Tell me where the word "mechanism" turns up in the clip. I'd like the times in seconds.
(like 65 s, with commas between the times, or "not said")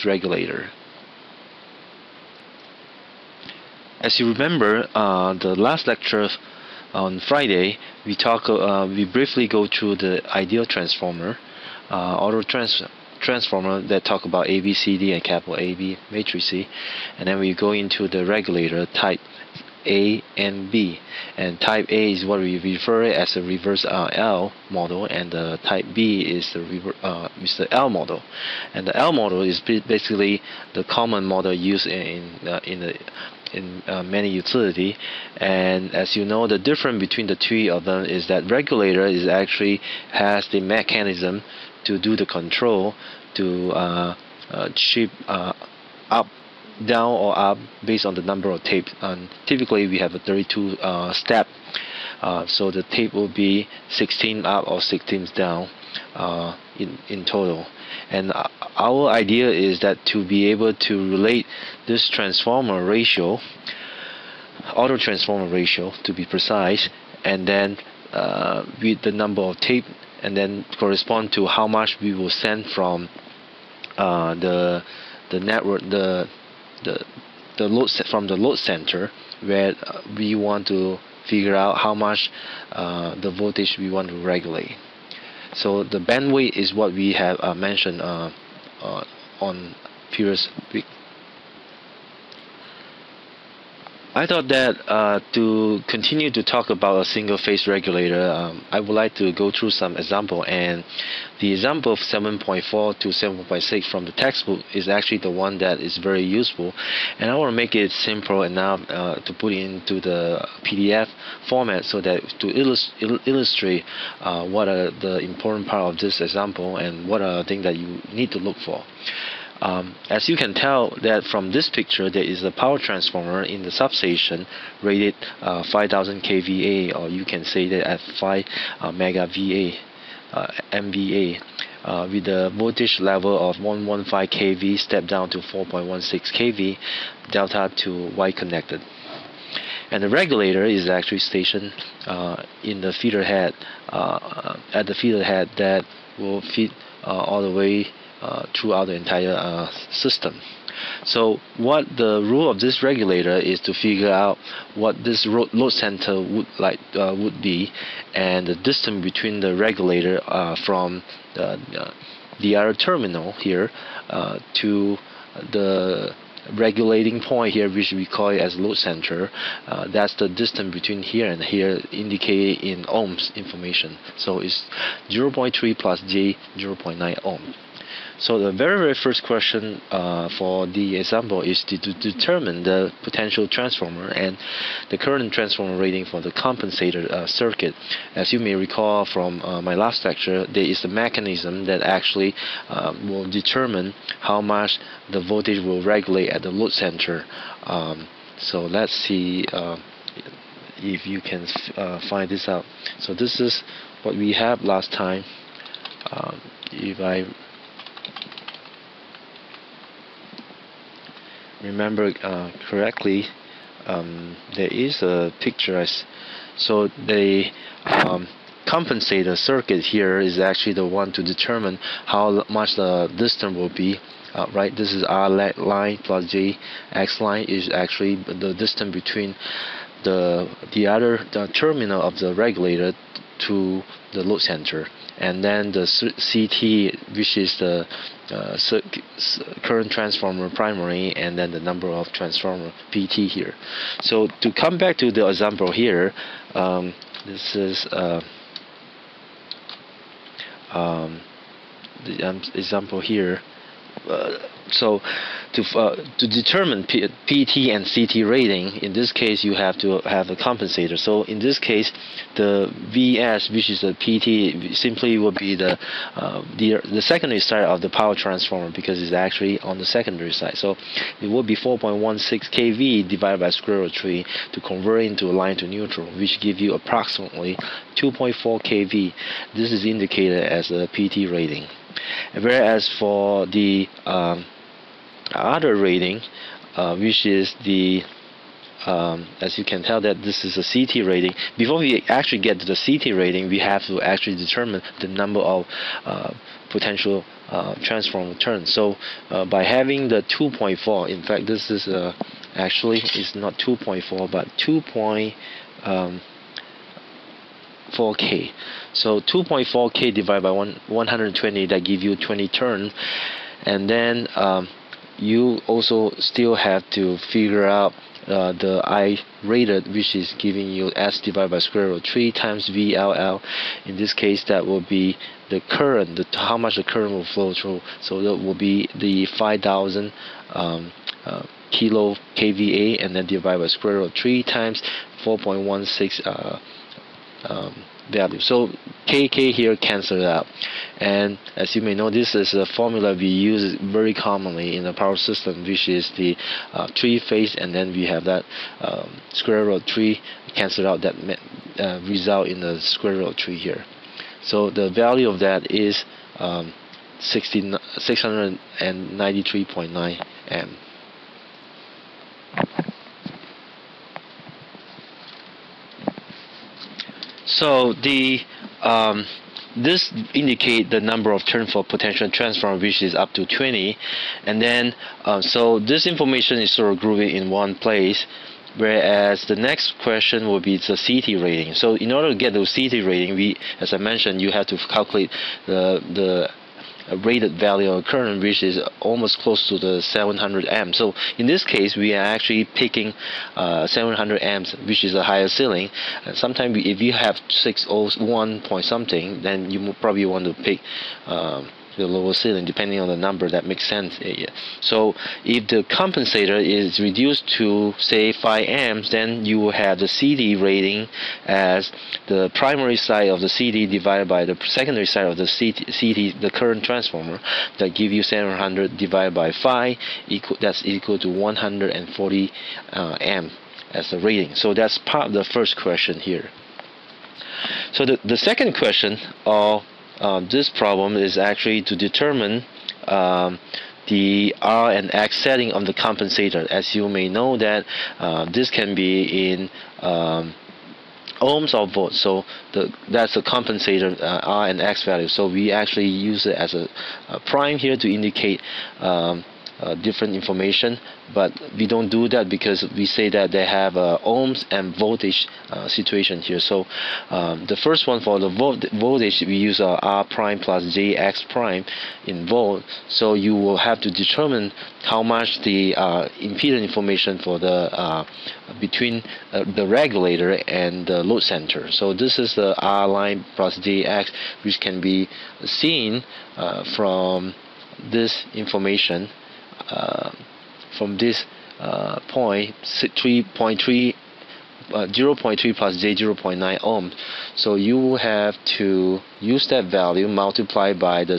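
40 s, 190 s.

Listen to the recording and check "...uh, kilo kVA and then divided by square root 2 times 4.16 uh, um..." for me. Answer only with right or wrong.
wrong.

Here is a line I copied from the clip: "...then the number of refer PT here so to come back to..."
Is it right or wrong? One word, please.
wrong.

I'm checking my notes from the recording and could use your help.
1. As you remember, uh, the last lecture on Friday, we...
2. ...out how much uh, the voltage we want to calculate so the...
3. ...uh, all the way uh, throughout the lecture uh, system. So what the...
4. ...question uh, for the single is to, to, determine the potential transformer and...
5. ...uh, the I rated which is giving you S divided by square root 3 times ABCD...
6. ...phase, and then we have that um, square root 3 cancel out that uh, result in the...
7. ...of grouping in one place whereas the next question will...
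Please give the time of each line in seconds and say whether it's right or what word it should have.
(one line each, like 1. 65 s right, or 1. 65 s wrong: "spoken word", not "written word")
1. 4 s right
2. 81 s wrong: "regulate", not "calculate"
3. 147 s wrong: "entire", not "lecture"
4. 179 s wrong: "example", not "single"
5. 318 s wrong: "VLL", not "ABCD"
6. 347 s right
7. 376 s right.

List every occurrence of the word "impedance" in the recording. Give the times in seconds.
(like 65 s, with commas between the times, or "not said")
466 s.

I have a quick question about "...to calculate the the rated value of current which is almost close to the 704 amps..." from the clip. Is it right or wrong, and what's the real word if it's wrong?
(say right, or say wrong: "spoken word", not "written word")
wrong: "700", not "704".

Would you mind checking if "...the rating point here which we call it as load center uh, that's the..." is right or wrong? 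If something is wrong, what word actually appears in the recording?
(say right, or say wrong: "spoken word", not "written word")
wrong: "regulating", not "rating".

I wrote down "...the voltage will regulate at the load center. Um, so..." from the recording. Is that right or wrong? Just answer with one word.
right.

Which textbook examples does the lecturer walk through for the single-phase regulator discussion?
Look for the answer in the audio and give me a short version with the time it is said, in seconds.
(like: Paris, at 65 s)
7.4 to 7.6, at 101 s.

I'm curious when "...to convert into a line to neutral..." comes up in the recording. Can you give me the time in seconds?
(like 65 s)
274 s.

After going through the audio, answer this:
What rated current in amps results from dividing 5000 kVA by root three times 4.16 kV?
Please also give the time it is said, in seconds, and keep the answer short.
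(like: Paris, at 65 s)
693.9, at 357 s.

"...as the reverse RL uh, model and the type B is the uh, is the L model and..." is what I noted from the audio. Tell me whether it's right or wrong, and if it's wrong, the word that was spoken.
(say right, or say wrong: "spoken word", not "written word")
right.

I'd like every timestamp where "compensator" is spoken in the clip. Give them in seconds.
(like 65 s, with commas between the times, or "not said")
186 s, 218 s, 260 s, 405 s, 435 s, 443 s.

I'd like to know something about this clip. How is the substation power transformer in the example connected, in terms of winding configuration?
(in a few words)
delta to Y.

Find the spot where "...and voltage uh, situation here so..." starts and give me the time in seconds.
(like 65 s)
454 s.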